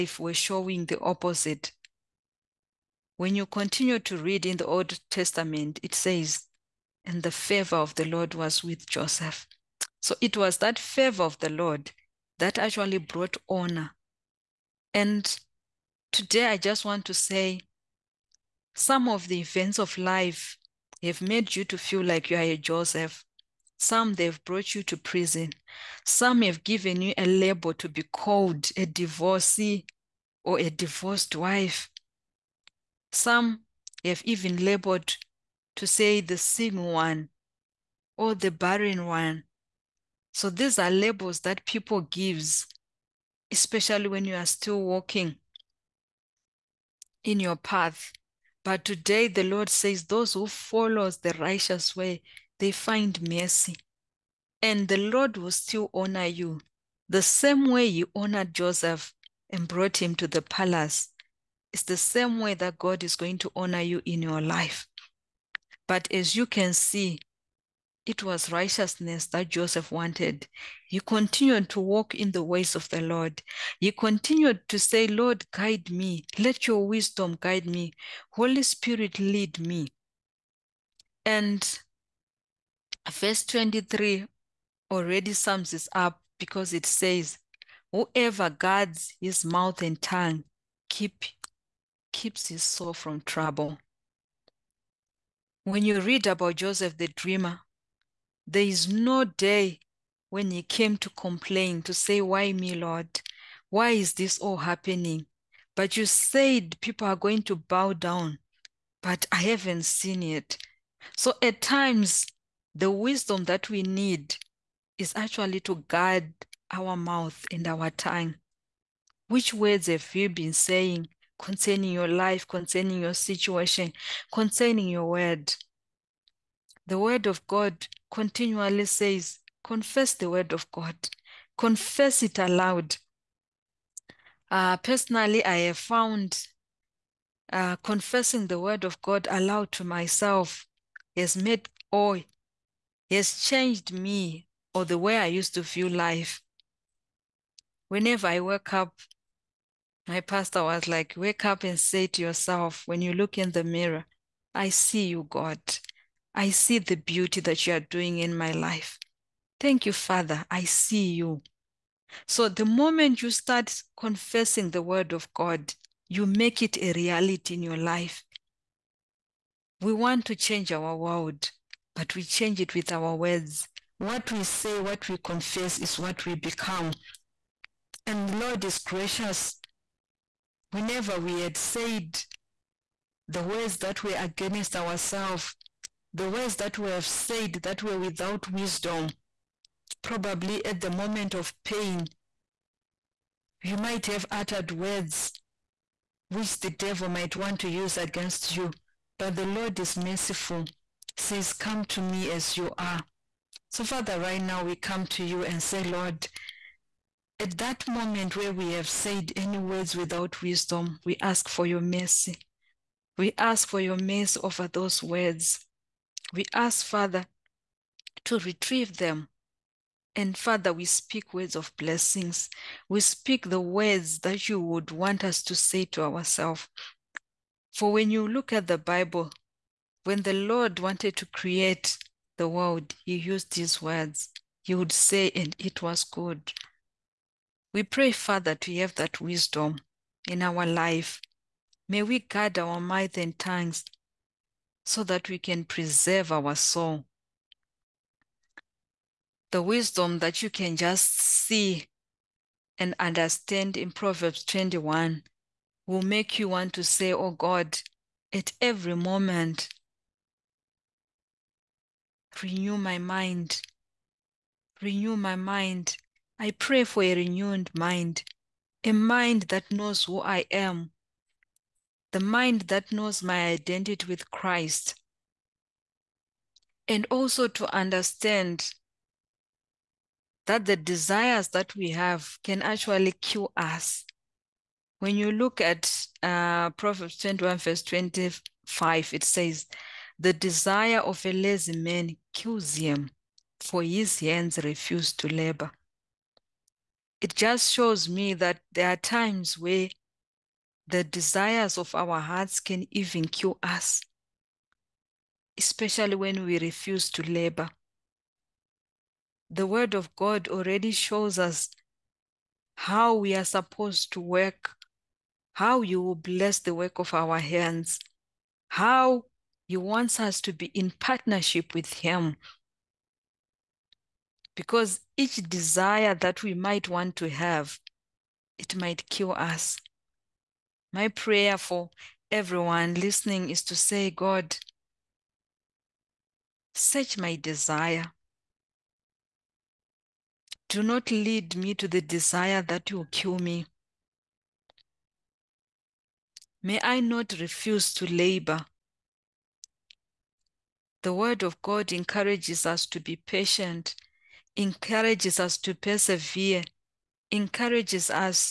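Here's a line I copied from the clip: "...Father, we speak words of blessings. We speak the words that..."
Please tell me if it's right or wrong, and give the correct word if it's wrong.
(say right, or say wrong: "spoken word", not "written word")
right.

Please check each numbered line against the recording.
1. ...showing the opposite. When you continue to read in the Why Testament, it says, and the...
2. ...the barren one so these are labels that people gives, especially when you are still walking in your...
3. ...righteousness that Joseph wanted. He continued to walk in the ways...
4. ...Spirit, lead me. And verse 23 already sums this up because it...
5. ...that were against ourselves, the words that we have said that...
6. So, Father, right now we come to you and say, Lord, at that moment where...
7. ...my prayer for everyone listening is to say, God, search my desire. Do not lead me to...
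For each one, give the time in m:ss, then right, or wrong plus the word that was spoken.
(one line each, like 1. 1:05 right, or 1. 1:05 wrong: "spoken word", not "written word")
1. 0:00 wrong: "Old", not "Why"
2. 0:38 right
3. 1:08 right
4. 1:18 right
5. 3:03 right
6. 3:23 right
7. 5:30 right.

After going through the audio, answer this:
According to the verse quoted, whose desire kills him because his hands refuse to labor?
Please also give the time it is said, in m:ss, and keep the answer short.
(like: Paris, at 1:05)
A lazy man, at 4:51.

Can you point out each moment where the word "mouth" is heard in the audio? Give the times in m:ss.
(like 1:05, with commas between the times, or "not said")
1:29, 1:56, 4:02.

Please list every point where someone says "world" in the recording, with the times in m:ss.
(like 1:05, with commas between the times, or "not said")
2:50, 3:52.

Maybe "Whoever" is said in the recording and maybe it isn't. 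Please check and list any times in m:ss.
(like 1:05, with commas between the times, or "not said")
1:27.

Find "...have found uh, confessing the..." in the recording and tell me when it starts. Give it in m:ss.
2:15.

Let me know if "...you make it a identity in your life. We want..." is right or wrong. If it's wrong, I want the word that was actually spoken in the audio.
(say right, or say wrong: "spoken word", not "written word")
wrong: "reality", not "identity".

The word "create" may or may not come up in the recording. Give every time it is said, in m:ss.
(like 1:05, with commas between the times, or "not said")
3:51.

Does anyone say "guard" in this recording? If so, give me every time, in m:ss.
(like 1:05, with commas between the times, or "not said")
1:28, 1:55, 4:02.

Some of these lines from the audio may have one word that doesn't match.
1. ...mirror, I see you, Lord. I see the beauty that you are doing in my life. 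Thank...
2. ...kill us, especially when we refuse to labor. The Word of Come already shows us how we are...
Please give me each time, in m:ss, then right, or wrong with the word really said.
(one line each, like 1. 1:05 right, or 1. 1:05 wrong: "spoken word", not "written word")
1. 2:33 wrong: "God", not "Lord"
2. 5:03 wrong: "God", not "Come".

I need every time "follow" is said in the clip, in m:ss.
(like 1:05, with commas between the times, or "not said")
0:50.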